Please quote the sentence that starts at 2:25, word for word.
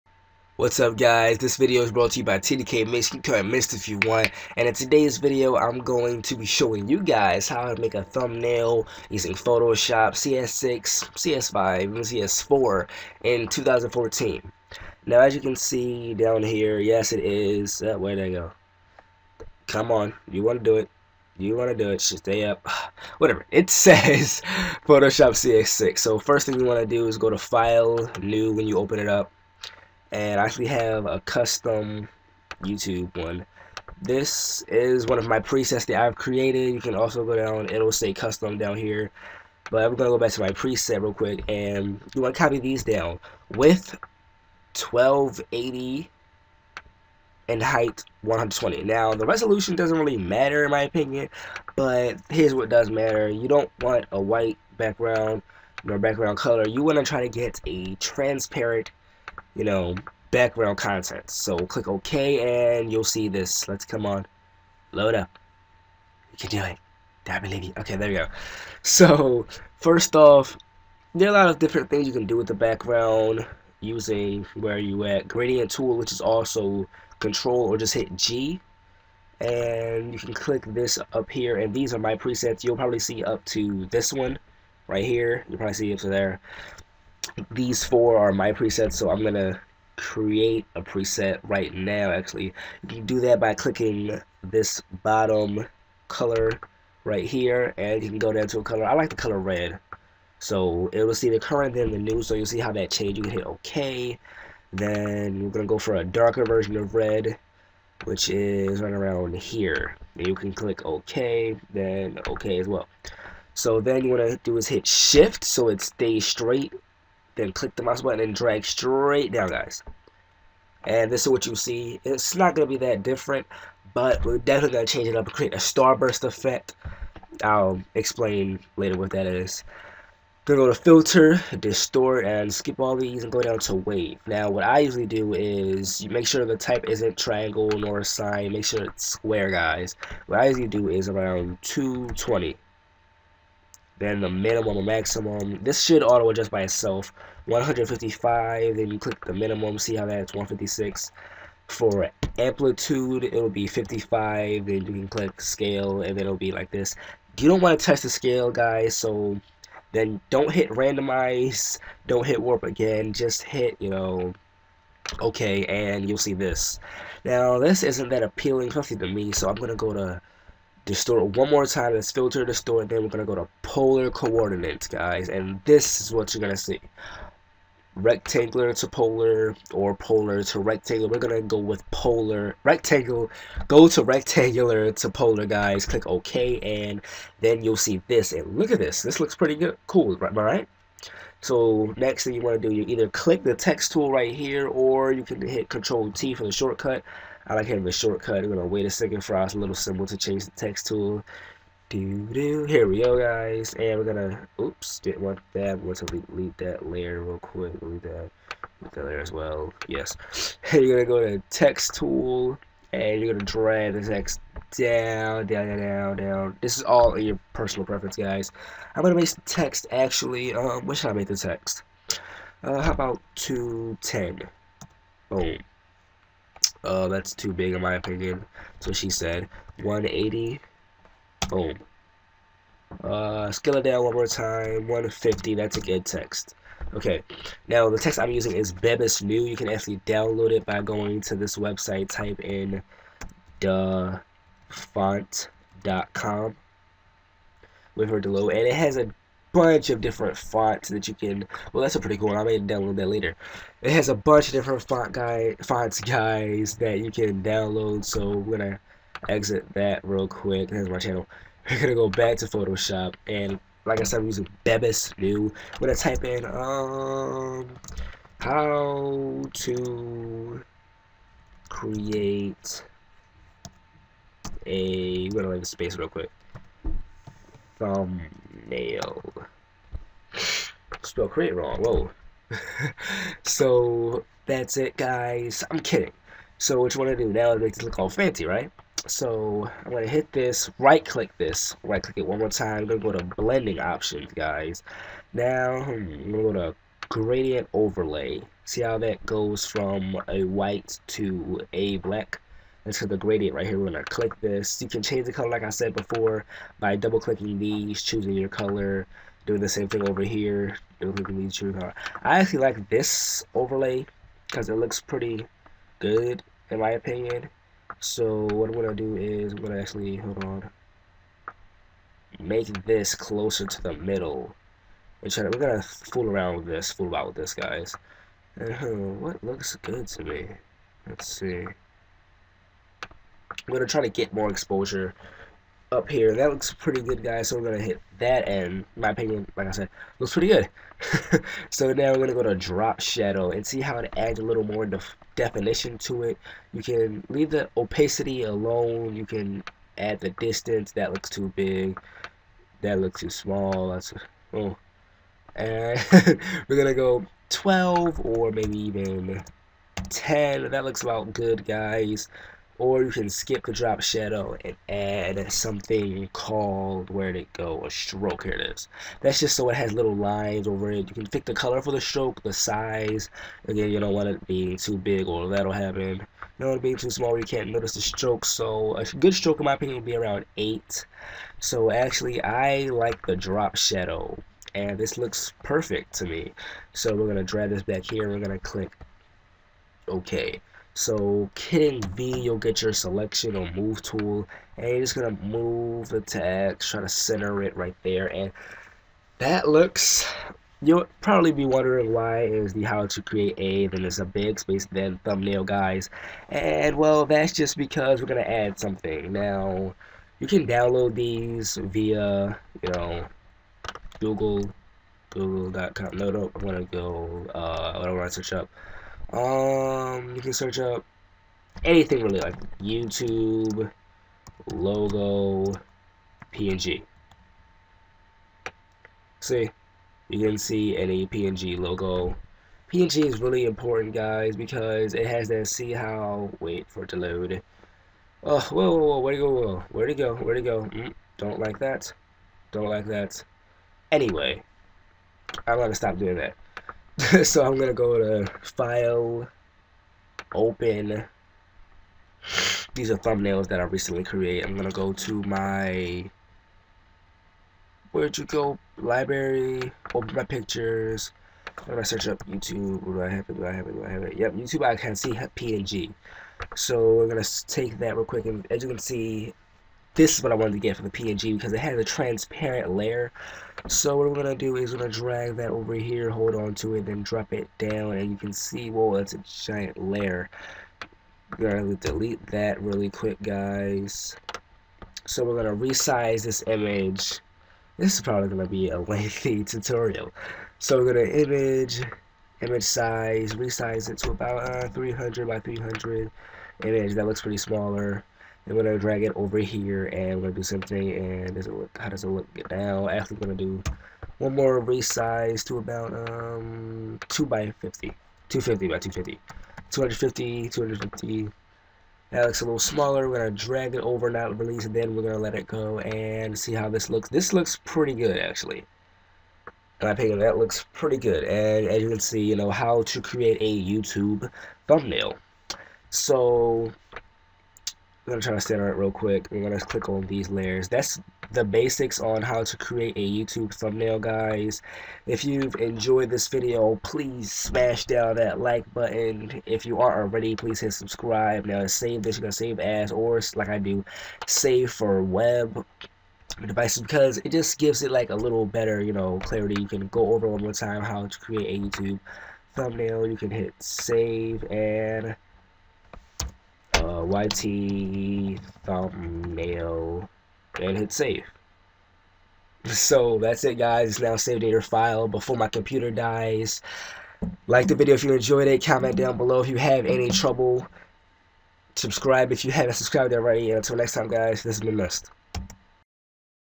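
This should auto adjust by itself.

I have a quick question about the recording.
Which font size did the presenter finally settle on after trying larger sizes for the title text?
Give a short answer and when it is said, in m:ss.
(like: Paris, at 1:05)
150, at 3:54.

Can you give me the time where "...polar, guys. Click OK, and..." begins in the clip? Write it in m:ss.
3:05.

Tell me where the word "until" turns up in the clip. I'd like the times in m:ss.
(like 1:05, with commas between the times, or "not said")
9:33.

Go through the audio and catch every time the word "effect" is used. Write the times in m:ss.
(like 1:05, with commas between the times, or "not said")
2:06.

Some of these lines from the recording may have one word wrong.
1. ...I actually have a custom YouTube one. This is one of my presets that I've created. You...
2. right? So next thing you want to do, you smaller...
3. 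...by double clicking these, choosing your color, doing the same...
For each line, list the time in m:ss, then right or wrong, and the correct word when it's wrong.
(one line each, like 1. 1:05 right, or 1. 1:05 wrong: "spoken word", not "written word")
1. 0:30 right
2. 3:10 wrong: "either", not "smaller"
3. 5:06 right.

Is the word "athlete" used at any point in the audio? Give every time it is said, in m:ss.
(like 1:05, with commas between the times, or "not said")
not said.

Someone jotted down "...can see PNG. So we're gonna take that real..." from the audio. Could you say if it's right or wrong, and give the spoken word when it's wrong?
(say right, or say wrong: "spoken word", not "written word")
right.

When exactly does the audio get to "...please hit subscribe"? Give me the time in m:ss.
9:00.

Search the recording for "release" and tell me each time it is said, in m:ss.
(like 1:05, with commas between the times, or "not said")
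8:34.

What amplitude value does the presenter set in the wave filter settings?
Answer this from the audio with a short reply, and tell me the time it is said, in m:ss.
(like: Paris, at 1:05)
55, at 2:33.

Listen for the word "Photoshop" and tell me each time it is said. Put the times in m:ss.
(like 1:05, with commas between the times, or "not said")
0:09, 0:24, 4:22.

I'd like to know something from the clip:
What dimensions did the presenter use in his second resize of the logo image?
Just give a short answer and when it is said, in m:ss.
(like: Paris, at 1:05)
250 by 250, at 8:28.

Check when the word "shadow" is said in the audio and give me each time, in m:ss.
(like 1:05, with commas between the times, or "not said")
5:43, 6:04, 6:23.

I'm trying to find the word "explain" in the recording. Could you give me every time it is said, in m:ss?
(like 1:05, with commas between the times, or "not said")
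2:07.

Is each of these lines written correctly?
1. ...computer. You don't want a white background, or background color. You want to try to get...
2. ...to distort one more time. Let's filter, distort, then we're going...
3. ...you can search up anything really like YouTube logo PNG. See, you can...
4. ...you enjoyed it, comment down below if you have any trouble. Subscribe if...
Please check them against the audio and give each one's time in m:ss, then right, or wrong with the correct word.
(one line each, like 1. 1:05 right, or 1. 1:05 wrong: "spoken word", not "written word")
1. 0:52 wrong: "matter", not "computer"
2. 2:49 right
3. 7:00 right
4. 9:28 right.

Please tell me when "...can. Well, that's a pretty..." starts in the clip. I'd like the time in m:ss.
4:11.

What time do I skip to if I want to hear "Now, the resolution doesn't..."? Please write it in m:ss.
0:48.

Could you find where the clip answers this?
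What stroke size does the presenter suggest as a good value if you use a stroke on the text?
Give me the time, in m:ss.
6:20.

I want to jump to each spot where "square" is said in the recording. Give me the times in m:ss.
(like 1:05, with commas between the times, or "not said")
2:19.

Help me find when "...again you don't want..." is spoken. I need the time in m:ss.
6:13.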